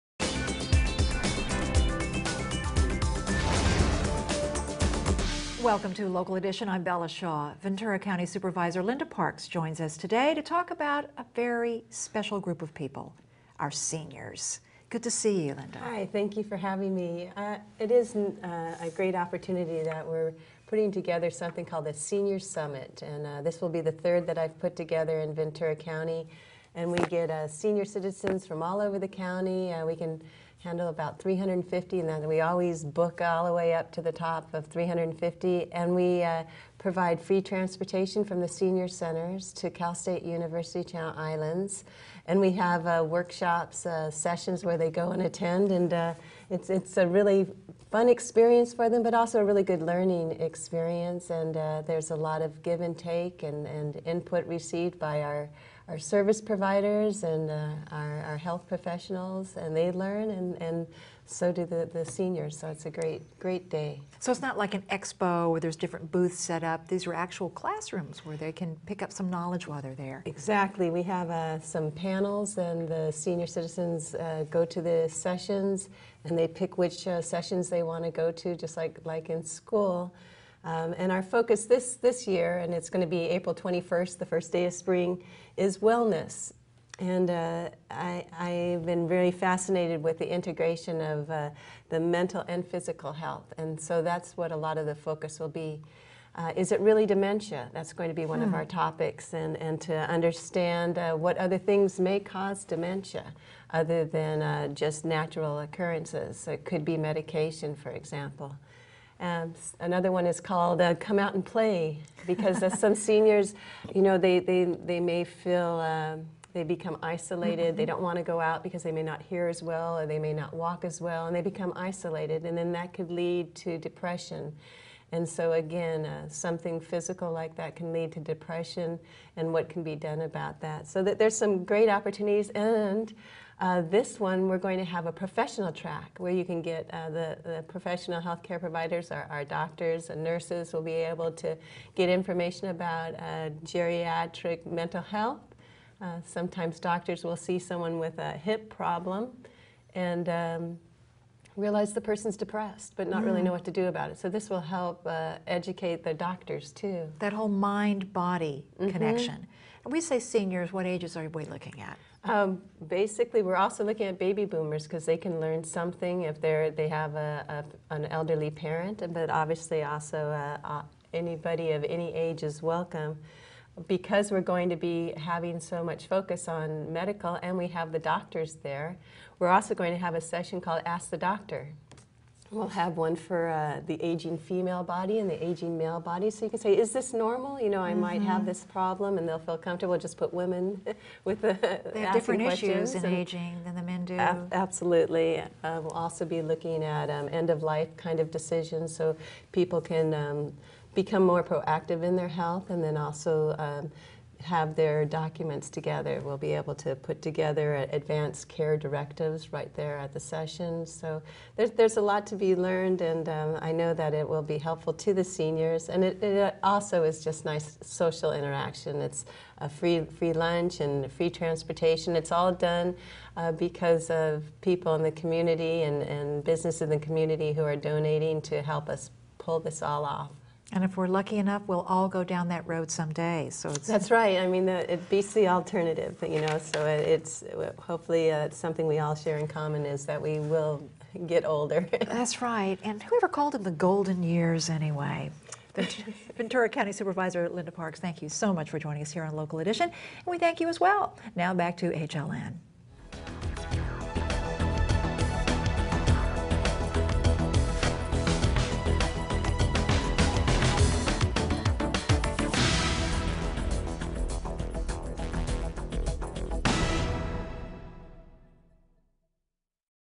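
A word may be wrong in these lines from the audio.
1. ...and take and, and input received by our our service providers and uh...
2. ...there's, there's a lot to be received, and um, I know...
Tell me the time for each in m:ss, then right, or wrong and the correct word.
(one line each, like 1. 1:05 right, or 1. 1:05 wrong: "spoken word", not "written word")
1. 0:52 right
2. 3:31 wrong: "learned", not "received".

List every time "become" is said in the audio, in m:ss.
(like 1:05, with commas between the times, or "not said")
1:56, 2:01, 3:20.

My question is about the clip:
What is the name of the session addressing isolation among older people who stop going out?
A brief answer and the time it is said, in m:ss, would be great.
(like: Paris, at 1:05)
Come Out and Play, at 1:50.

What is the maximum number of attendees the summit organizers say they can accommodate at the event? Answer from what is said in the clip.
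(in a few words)
350.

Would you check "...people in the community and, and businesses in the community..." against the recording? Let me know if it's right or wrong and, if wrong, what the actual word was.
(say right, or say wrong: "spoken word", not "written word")
right.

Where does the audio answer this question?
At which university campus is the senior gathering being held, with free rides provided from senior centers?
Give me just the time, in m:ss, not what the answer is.
0:39.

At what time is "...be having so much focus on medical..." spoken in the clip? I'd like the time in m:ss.
2:54.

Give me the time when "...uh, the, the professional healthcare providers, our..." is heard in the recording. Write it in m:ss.
2:16.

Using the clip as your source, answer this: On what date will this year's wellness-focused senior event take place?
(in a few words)
April 21st.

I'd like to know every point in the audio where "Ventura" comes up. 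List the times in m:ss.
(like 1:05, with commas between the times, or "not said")
0:07, 0:25, 4:06.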